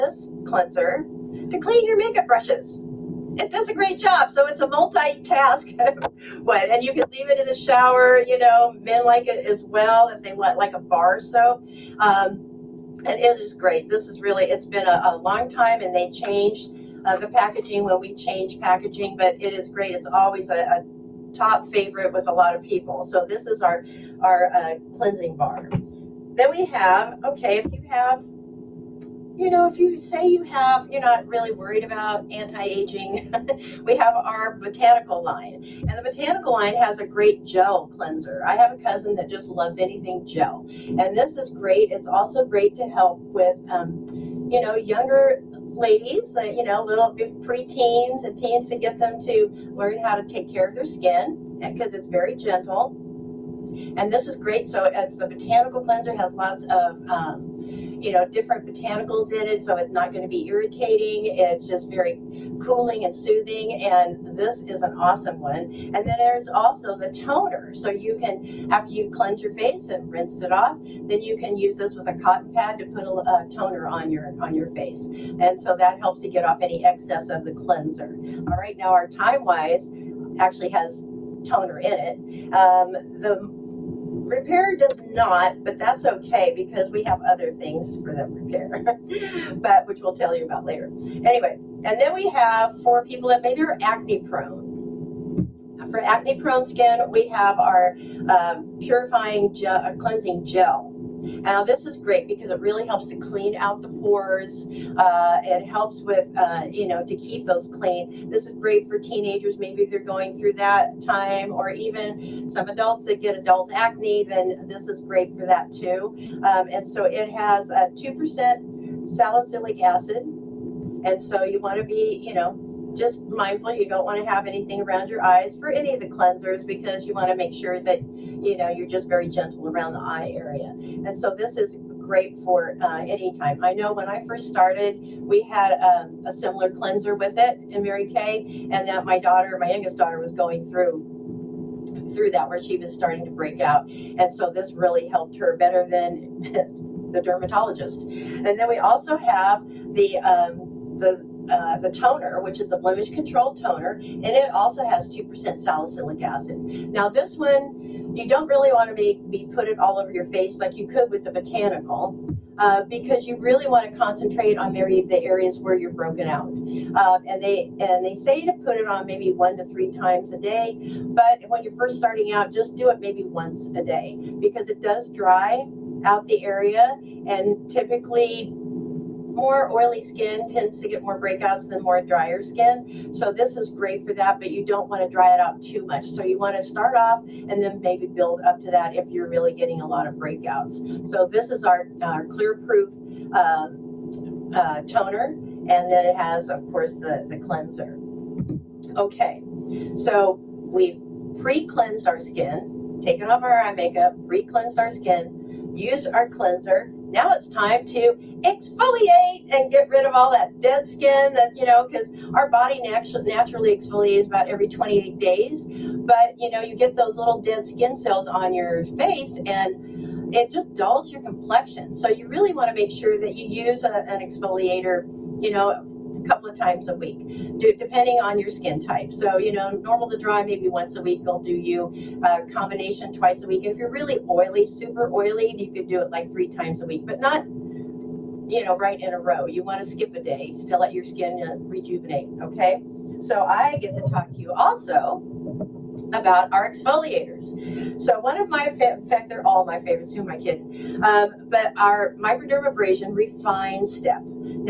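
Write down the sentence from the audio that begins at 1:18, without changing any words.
All right, now our time wise actually has toner in it.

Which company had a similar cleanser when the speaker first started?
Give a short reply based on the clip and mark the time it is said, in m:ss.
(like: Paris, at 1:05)
Mary Kay, at 2:17.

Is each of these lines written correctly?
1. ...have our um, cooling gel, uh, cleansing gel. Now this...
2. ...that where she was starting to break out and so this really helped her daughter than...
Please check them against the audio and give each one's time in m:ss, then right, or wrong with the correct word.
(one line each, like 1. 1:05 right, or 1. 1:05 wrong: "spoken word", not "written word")
1. 1:37 wrong: "purifying", not "cooling"
2. 2:22 wrong: "better", not "daughter".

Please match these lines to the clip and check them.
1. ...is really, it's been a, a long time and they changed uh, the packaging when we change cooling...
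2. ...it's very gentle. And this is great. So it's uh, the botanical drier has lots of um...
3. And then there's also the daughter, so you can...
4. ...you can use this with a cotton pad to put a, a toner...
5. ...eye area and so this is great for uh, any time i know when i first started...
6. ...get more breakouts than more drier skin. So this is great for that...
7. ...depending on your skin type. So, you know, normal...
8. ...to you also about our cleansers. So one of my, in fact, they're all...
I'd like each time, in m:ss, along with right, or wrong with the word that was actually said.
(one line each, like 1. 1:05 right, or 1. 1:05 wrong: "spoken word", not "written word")
1. 0:14 wrong: "packaging", not "cooling"
2. 0:51 wrong: "cleanser", not "drier"
3. 1:05 wrong: "toner", not "daughter"
4. 1:11 right
5. 2:09 right
6. 3:00 right
7. 3:47 right
8. 4:04 wrong: "exfoliators", not "cleansers".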